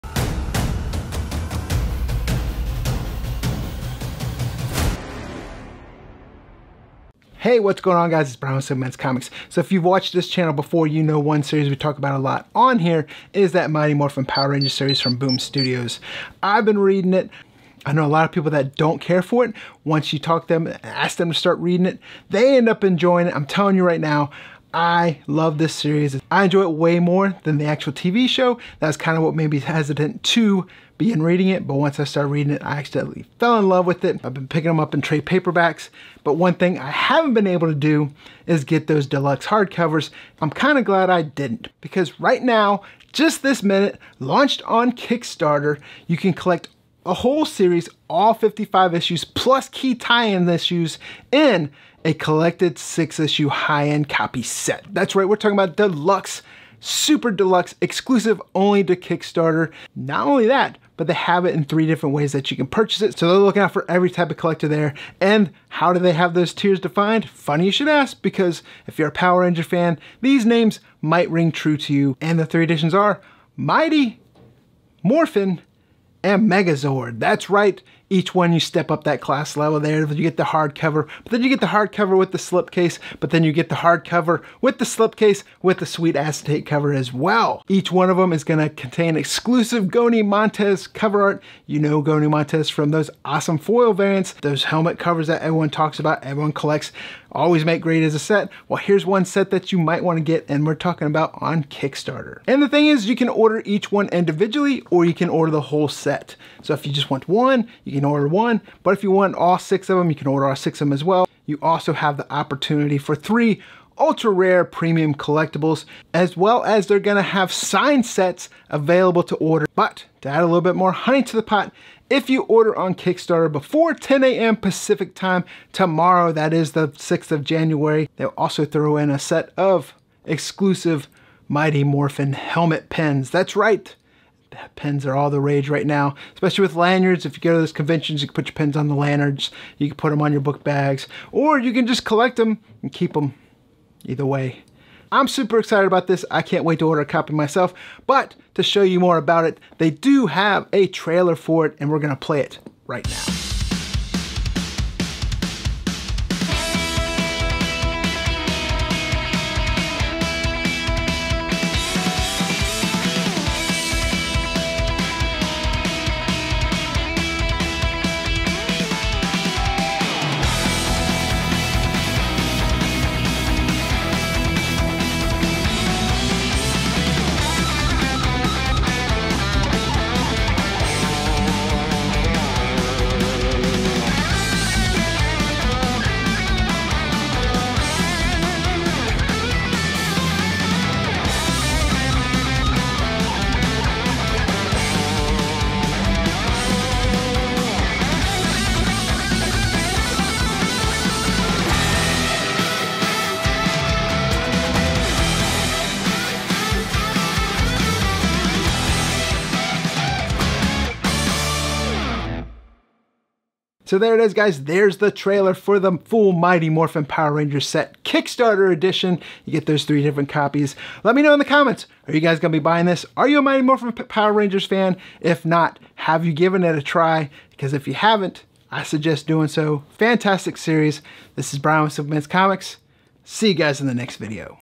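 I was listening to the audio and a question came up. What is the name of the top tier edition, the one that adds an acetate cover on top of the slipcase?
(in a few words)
Megazord.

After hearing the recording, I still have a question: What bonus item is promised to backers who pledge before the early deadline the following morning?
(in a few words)
Mighty Morphin helmet pins.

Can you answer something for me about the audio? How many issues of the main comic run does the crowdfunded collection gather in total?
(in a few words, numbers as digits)
55.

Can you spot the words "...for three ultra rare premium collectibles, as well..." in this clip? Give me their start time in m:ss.
1:52.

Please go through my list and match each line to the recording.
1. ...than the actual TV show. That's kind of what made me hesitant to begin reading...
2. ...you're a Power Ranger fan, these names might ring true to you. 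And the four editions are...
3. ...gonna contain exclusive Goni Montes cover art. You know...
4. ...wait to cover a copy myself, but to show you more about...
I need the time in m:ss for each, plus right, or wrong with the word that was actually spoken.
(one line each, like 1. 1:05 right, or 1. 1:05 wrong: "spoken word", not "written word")
1. 0:27 right
2. 1:08 wrong: "three", not "four"
3. 1:28 right
4. 2:26 wrong: "order", not "cover".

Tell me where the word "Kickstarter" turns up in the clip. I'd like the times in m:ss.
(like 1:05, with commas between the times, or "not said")
0:44, 0:58, 1:41, 2:02, 3:38.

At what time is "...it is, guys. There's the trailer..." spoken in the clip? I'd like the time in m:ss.
3:34.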